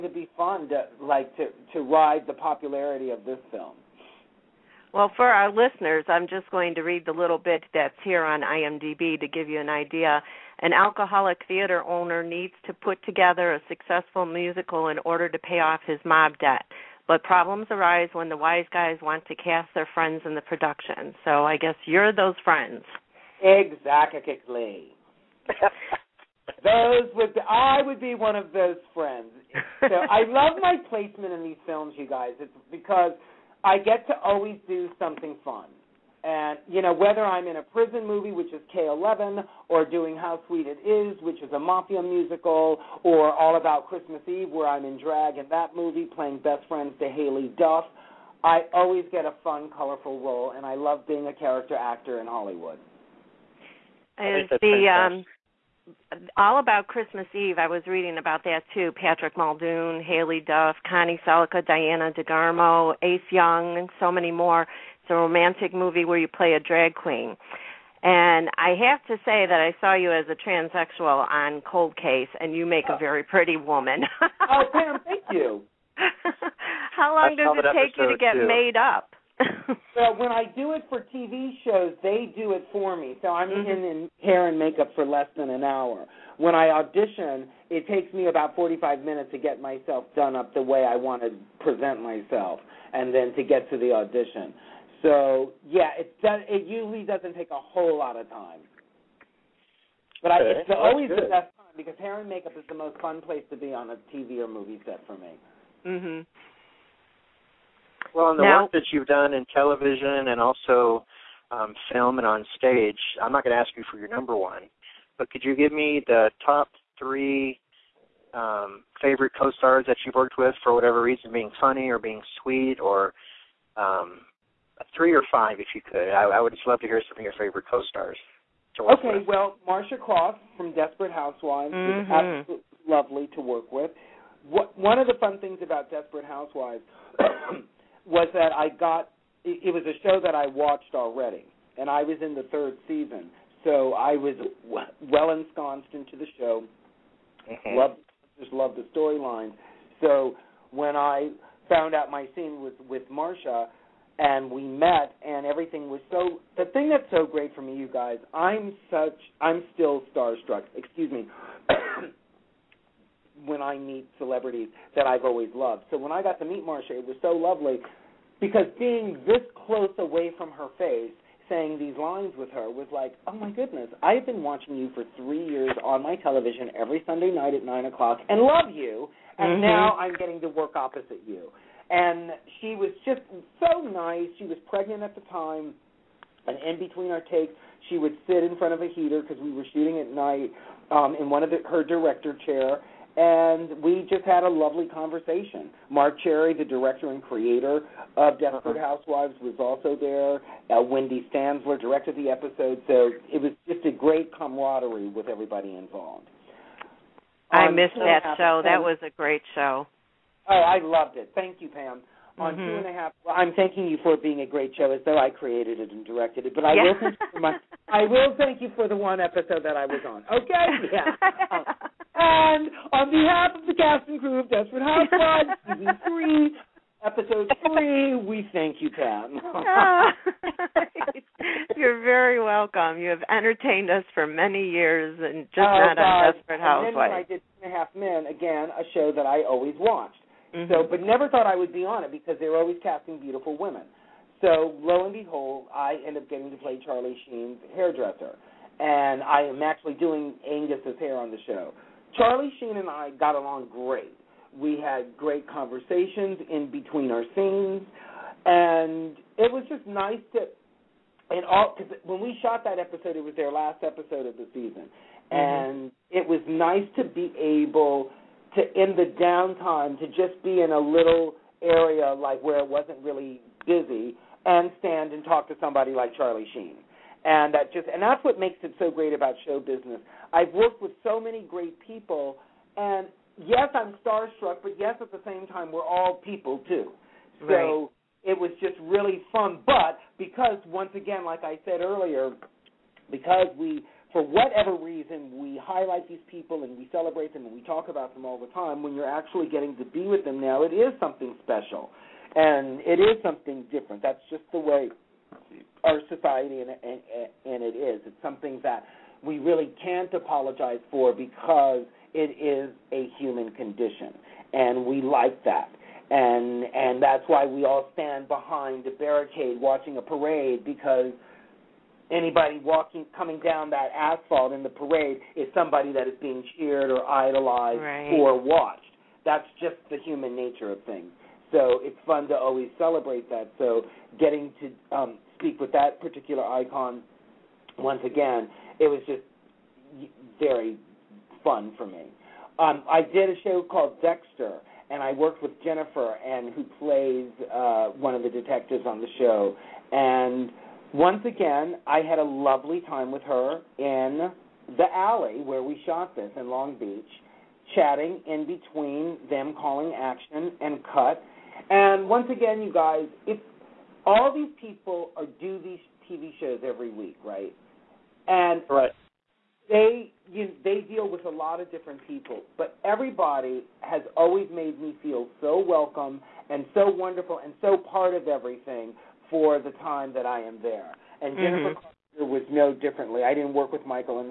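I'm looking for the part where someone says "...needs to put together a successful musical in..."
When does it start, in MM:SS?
00:12.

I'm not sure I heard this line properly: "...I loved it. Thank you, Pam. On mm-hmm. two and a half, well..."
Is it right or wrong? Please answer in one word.
right.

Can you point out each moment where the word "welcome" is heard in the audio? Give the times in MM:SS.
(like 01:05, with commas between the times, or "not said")
03:52, 06:15.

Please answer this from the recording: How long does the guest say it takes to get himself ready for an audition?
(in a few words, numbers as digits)
45 minutes.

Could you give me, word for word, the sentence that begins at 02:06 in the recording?
I, I would just love to hear some of your favorite co-stars.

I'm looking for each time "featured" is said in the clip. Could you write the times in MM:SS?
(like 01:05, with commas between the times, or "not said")
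not said.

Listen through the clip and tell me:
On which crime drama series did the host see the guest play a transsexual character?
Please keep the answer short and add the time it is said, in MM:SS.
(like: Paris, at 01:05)
Cold Case, at 01:11.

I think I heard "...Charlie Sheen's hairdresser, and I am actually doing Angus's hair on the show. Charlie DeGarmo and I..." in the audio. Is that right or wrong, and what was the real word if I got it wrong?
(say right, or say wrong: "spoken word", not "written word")
wrong: "Sheen", not "DeGarmo".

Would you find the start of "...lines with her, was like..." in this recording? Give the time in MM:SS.
02:51.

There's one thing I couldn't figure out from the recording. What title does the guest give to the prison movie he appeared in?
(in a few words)
K11.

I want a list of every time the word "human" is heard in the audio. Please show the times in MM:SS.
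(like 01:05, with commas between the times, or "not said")
05:13, 05:30.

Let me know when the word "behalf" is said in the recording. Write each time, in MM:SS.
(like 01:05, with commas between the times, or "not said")
03:43.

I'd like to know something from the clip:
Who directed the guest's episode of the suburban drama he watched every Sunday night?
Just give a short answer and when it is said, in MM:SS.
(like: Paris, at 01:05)
Wendey Stanzler, at 03:20.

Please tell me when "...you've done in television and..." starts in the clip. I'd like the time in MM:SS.
01:48.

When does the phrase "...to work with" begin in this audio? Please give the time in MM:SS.
02:13.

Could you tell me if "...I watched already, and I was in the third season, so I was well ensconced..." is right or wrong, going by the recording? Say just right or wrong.
right.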